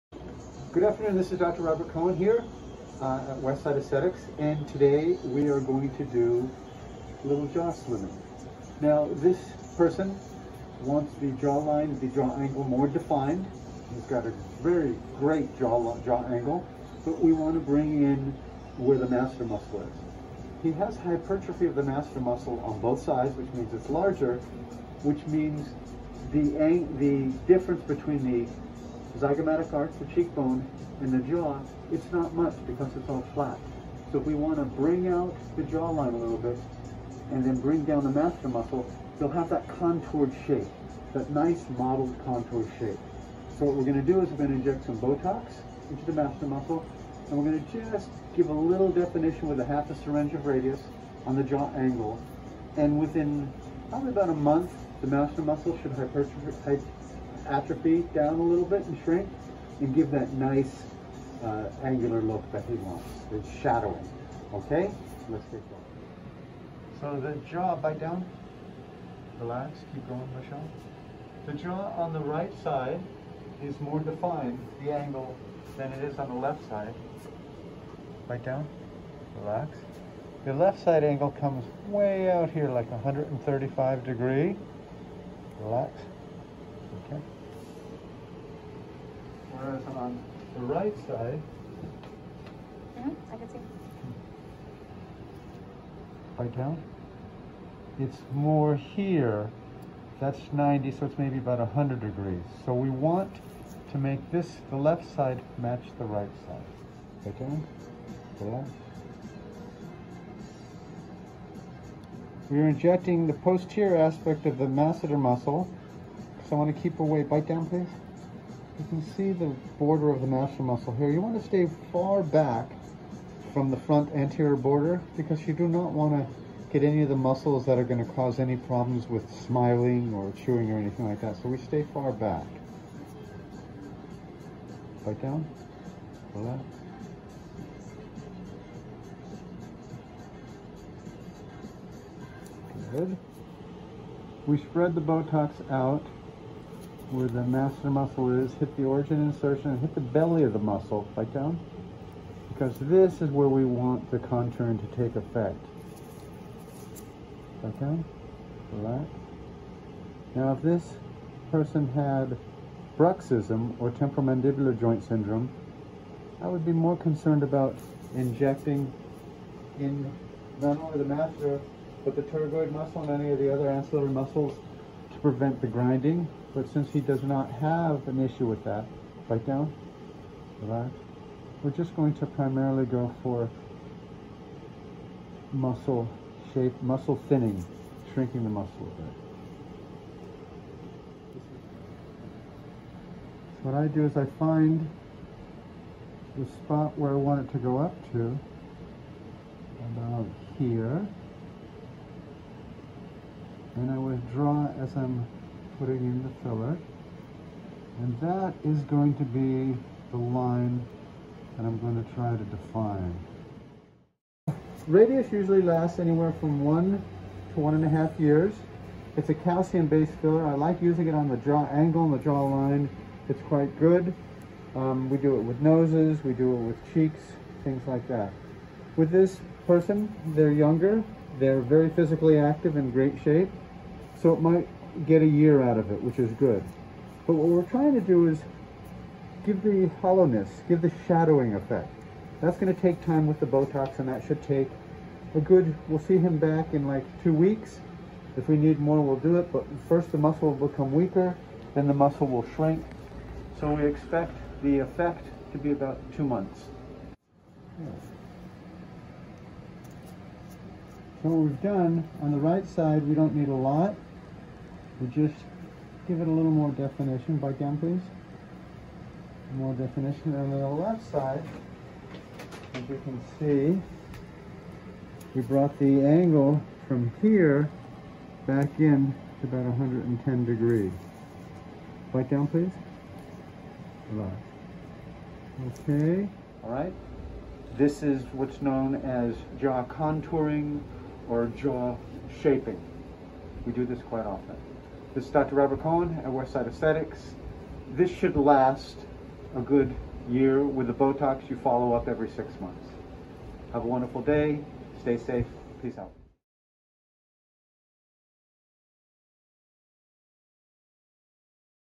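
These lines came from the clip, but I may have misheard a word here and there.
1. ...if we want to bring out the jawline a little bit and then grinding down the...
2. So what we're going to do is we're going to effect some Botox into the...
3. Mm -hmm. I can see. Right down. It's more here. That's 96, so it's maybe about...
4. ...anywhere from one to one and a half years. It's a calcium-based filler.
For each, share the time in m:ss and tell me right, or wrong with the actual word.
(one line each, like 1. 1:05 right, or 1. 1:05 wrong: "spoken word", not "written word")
1. 0:34 wrong: "bring", not "grinding"
2. 0:43 wrong: "inject", not "effect"
3. 1:32 wrong: "90", not "96"
4. 3:35 right.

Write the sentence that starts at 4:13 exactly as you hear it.
So we expect the effect to be about two months.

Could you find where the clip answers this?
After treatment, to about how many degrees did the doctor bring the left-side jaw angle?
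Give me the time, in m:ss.
4:39.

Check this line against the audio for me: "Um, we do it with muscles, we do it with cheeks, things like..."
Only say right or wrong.
wrong.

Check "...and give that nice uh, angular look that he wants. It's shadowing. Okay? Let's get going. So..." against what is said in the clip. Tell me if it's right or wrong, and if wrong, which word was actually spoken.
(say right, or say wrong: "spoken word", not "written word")
right.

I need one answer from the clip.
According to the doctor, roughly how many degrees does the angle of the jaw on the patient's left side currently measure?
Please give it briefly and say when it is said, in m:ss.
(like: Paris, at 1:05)
135 degrees, at 1:22.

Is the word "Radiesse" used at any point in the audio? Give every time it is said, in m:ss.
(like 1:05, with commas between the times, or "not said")
0:50, 3:34.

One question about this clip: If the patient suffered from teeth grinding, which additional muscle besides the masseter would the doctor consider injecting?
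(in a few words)
pterygoid muscle.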